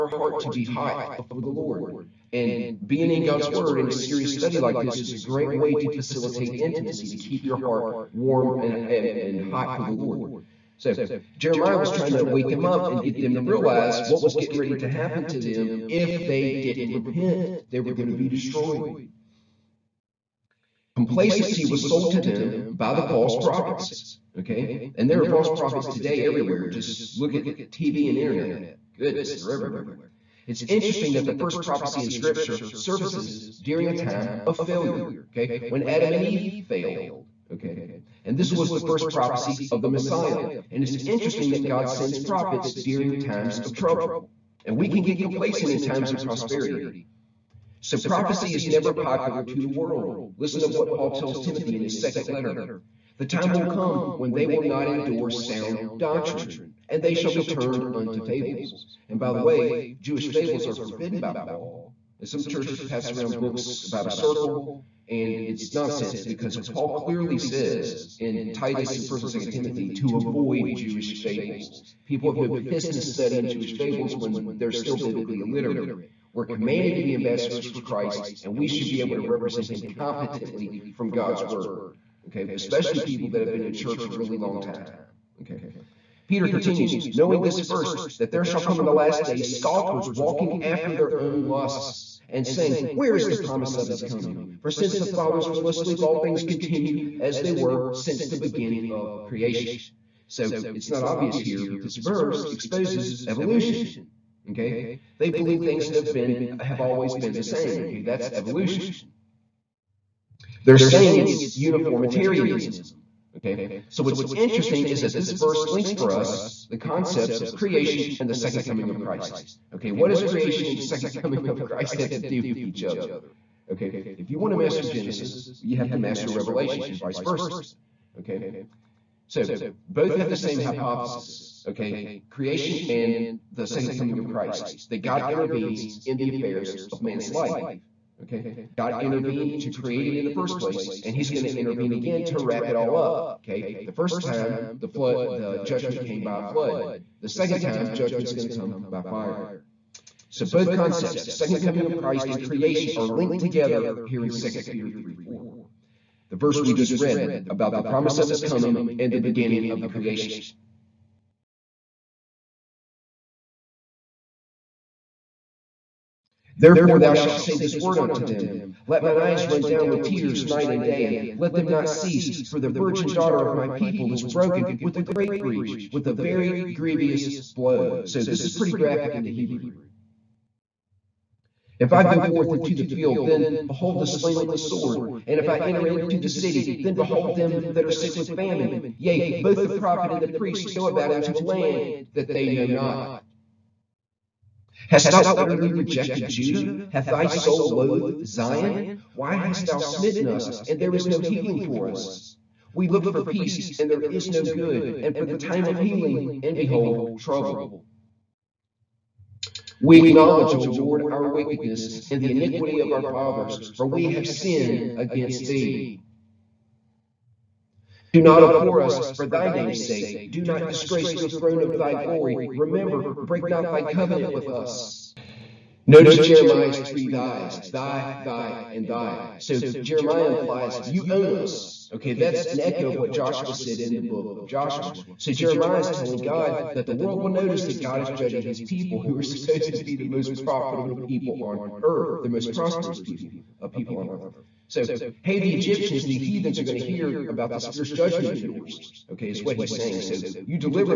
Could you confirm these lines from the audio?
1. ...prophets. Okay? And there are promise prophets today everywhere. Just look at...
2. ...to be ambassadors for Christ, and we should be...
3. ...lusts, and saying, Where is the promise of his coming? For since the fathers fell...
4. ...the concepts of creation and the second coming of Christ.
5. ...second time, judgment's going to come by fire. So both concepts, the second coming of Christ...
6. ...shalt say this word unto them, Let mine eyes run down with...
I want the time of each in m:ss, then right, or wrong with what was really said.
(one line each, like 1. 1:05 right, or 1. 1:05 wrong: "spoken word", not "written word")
1. 0:23 wrong: "false", not "promise"
2. 1:16 right
3. 1:31 right
4. 1:56 right
5. 2:27 right
6. 2:47 right.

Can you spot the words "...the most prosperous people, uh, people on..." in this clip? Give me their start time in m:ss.
4:02.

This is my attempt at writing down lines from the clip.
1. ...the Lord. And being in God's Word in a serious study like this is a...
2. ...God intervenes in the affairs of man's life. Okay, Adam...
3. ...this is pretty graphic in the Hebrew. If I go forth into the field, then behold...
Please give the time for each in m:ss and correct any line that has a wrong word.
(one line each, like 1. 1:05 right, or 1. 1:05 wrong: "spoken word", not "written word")
1. 0:01 right
2. 2:15 wrong: "God", not "Adam"
3. 2:58 right.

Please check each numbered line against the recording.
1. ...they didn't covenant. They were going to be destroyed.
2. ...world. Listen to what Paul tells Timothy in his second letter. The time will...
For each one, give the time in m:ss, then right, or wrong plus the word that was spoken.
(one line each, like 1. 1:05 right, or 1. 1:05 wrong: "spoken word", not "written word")
1. 0:16 wrong: "repent", not "covenant"
2. 0:49 right.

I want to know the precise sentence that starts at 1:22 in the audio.
Okay, especially people that have been in church a really long time.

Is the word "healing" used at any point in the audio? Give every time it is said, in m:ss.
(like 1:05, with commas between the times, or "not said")
3:21, 3:25.